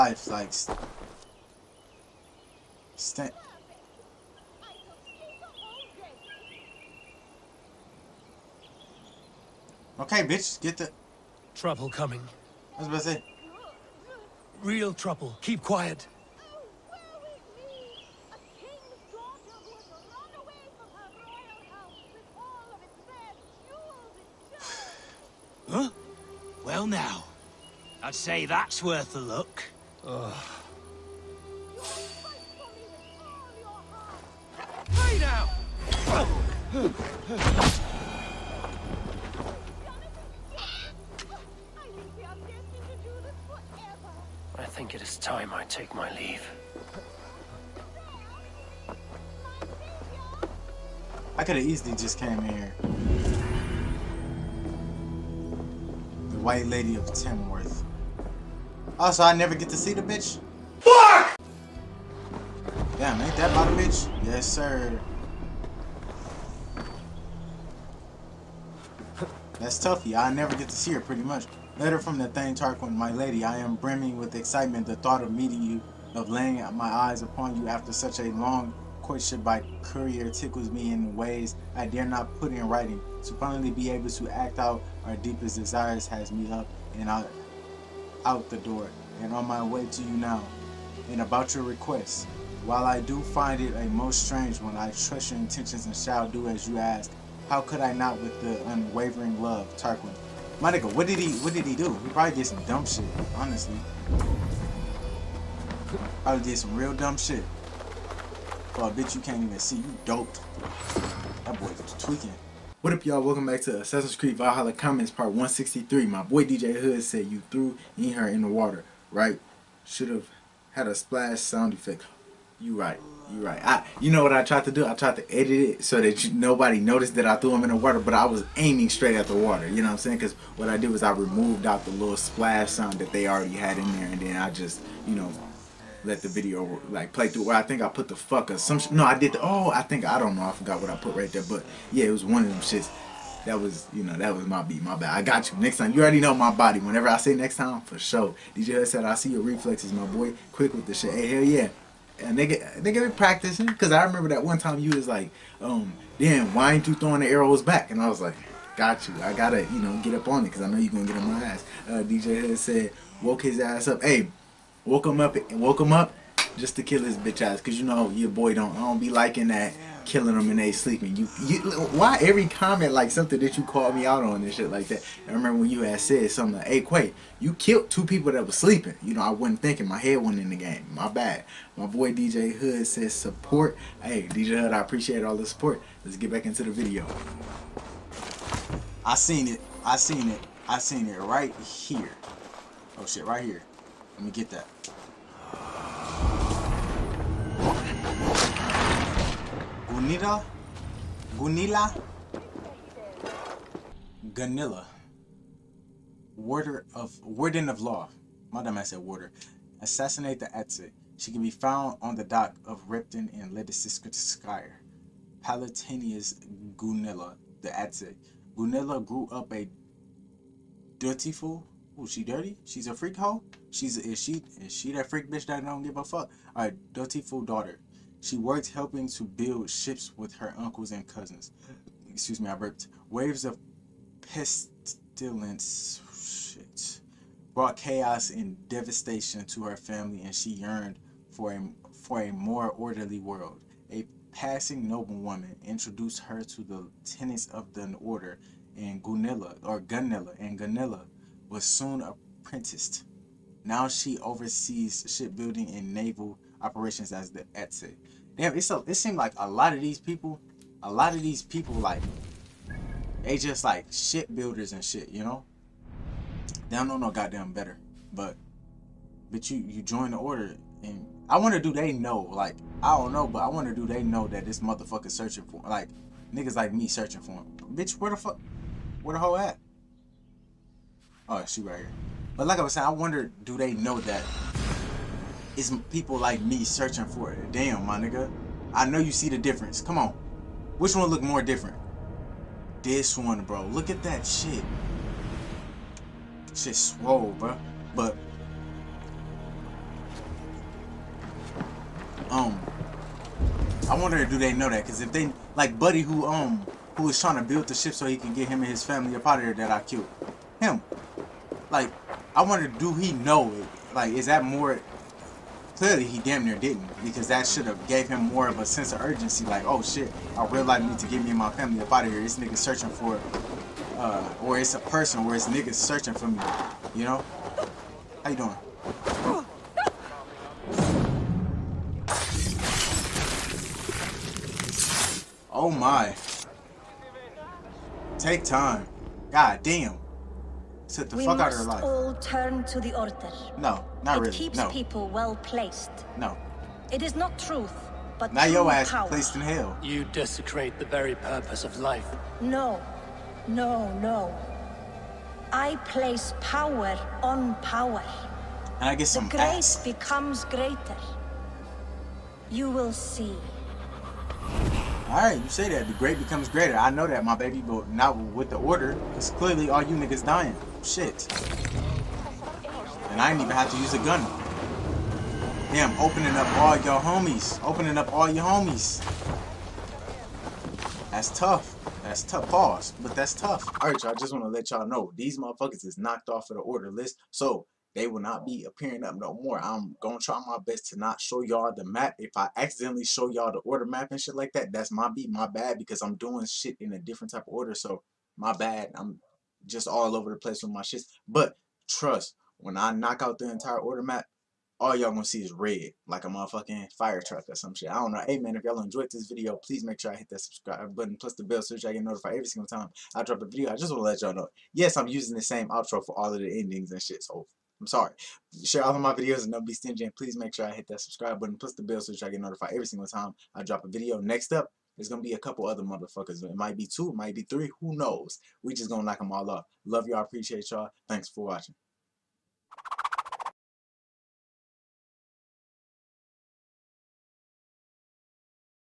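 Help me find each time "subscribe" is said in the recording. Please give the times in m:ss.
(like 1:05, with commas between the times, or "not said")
6:50, 7:00.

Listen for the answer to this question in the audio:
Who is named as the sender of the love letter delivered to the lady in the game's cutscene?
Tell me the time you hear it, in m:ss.
1:12.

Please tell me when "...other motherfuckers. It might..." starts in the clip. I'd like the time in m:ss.
7:05.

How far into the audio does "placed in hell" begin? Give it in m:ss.
5:49.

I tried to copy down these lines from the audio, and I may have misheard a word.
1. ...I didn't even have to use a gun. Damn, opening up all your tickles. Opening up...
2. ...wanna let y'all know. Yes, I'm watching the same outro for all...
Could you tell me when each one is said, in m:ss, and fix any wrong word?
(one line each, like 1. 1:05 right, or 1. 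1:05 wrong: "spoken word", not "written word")
1. 6:13 wrong: "homies", not "tickles"
2. 6:53 wrong: "using", not "watching".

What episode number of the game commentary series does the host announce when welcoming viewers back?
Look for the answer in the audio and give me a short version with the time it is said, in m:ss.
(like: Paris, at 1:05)
163, at 1:55.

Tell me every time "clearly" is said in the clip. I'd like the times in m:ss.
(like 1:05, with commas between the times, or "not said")
5:15, 6:09.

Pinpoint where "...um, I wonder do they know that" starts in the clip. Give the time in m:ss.
5:02.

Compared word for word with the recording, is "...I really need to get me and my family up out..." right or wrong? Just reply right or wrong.
right.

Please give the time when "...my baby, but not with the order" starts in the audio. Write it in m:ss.
6:07.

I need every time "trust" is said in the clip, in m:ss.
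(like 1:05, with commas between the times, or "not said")
1:34, 6:41.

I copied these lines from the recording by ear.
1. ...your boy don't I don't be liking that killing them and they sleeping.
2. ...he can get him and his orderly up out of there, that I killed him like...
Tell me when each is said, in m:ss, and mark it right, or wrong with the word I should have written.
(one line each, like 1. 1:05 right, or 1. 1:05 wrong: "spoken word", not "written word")
1. 2:48 right
2. 5:08 wrong: "family", not "orderly".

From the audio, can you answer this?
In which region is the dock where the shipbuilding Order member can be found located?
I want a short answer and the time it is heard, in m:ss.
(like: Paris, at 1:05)
Skyre, at 3:33.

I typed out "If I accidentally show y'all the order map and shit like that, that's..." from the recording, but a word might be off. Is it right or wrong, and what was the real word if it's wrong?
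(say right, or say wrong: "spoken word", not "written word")
right.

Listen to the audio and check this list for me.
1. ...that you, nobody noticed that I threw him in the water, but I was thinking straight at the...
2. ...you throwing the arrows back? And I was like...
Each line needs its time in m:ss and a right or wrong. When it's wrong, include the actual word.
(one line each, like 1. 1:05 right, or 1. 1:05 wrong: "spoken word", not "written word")
1. 2:06 wrong: "aiming", not "thinking"
2. 2:36 right.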